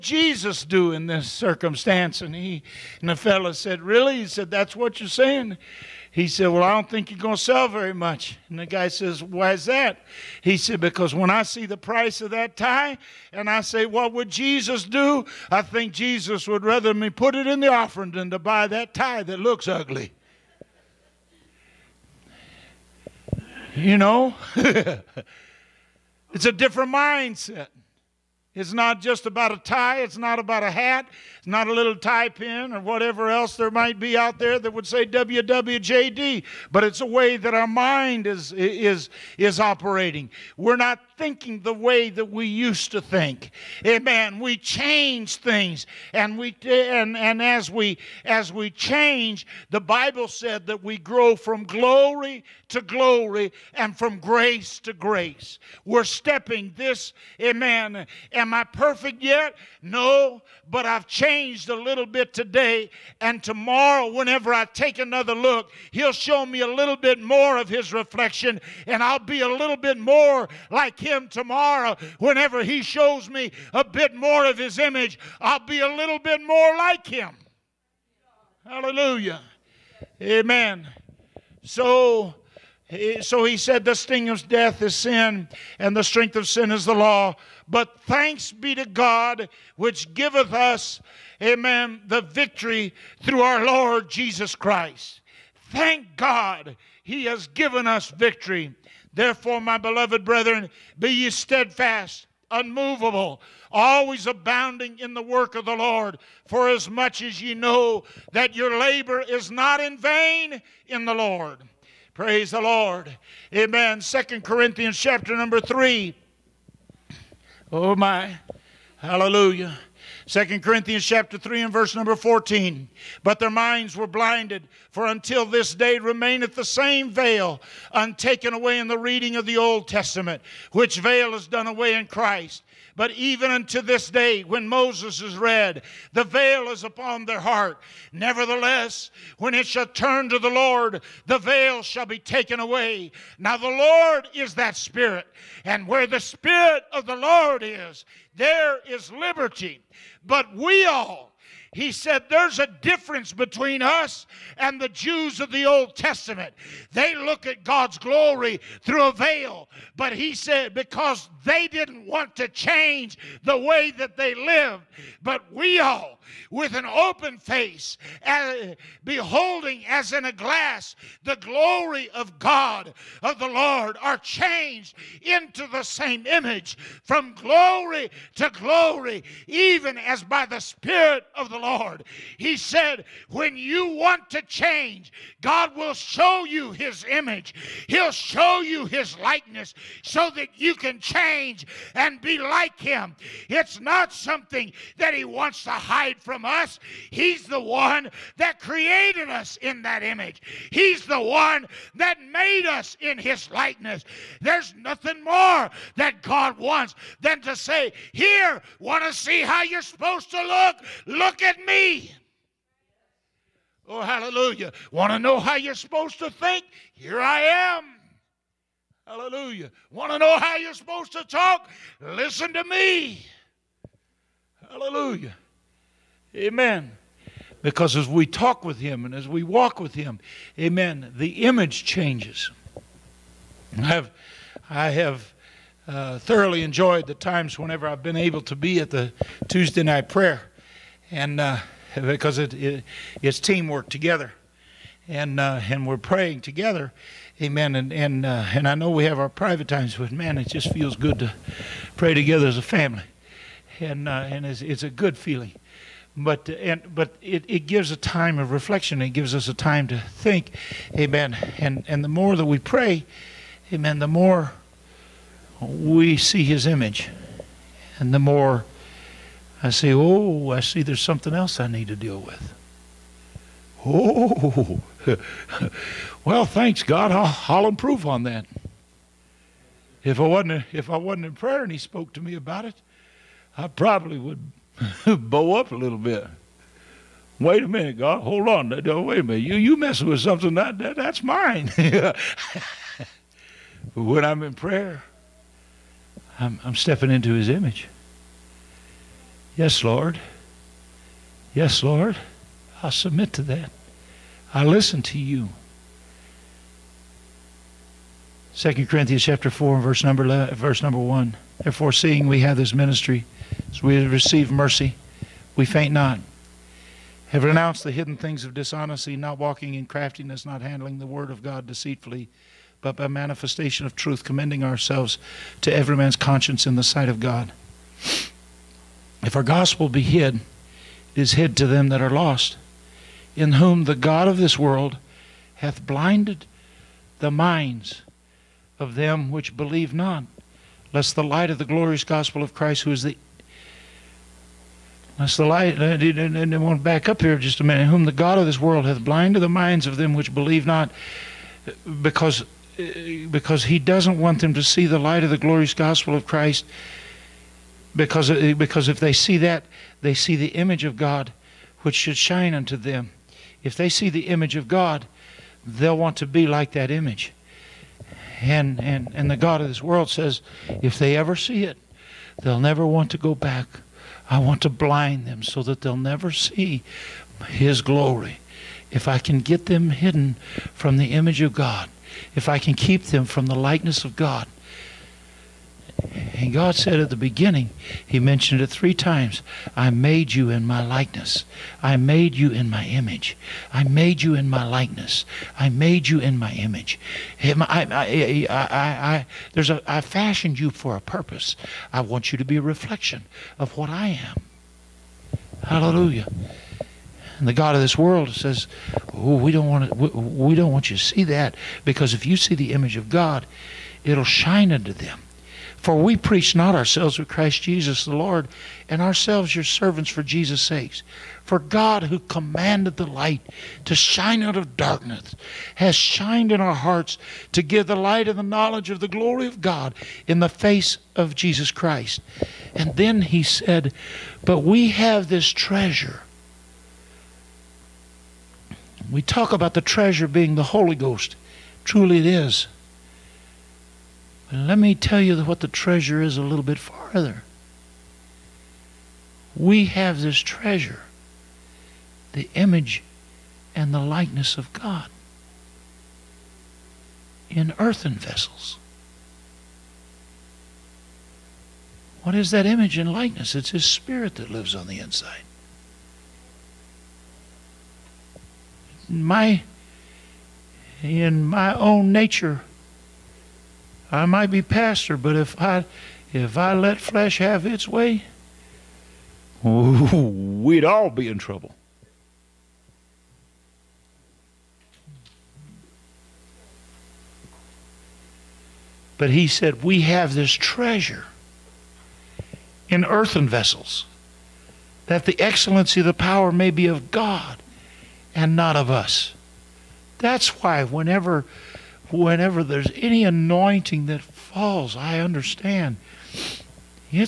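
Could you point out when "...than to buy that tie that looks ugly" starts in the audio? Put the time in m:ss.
0:18.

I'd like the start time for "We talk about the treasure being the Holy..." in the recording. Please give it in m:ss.
7:19.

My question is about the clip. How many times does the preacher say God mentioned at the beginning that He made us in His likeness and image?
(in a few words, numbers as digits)
3.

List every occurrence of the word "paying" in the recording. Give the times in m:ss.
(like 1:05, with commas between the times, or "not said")
not said.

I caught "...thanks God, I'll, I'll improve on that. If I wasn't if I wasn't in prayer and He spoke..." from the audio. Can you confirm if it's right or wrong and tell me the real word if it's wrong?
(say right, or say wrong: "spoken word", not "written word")
right.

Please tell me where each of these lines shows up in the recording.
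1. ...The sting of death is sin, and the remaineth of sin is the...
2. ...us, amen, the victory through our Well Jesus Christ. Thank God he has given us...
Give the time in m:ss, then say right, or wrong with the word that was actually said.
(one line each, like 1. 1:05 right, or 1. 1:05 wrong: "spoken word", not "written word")
1. 1:23 wrong: "strength", not "remaineth"
2. 1:30 wrong: "Lord", not "Well".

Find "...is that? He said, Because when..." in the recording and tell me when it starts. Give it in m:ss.
0:09.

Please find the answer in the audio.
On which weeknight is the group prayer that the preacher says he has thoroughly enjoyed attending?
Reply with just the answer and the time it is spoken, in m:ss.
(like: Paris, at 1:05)
Tuesday, at 3:59.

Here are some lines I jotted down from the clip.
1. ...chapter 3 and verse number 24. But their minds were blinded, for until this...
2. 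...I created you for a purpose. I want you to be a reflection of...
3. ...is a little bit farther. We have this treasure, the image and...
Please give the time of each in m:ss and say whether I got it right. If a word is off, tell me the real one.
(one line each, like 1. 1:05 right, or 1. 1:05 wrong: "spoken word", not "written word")
1. 2:01 wrong: "14", not "24"
2. 6:39 wrong: "fashioned", not "created"
3. 7:26 right.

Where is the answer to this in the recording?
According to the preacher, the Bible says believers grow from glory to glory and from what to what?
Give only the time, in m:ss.
0:53.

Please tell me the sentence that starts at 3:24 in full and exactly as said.
There's nothing more that God wants than to say, Here, want to see how you're supposed to look?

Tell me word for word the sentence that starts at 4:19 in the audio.
It gives us a time to think, Amen.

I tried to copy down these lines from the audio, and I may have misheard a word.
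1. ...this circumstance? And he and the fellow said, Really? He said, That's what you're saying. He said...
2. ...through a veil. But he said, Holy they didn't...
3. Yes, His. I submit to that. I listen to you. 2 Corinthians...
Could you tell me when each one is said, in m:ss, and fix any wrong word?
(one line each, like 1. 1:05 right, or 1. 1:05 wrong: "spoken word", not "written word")
1. 0:01 right
2. 2:38 wrong: "Because", not "Holy"
3. 5:01 wrong: "Lord", not "His".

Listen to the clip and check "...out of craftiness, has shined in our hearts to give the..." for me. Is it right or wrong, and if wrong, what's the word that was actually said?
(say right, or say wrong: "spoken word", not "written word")
wrong: "darkness", not "craftiness".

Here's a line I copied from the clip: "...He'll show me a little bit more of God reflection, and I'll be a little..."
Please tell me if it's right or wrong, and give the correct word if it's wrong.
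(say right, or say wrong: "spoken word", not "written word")
wrong: "His", not "God".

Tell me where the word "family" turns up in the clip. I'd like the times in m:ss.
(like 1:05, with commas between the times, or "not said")
4:12.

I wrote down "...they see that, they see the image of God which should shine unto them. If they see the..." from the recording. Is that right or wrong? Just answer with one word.
right.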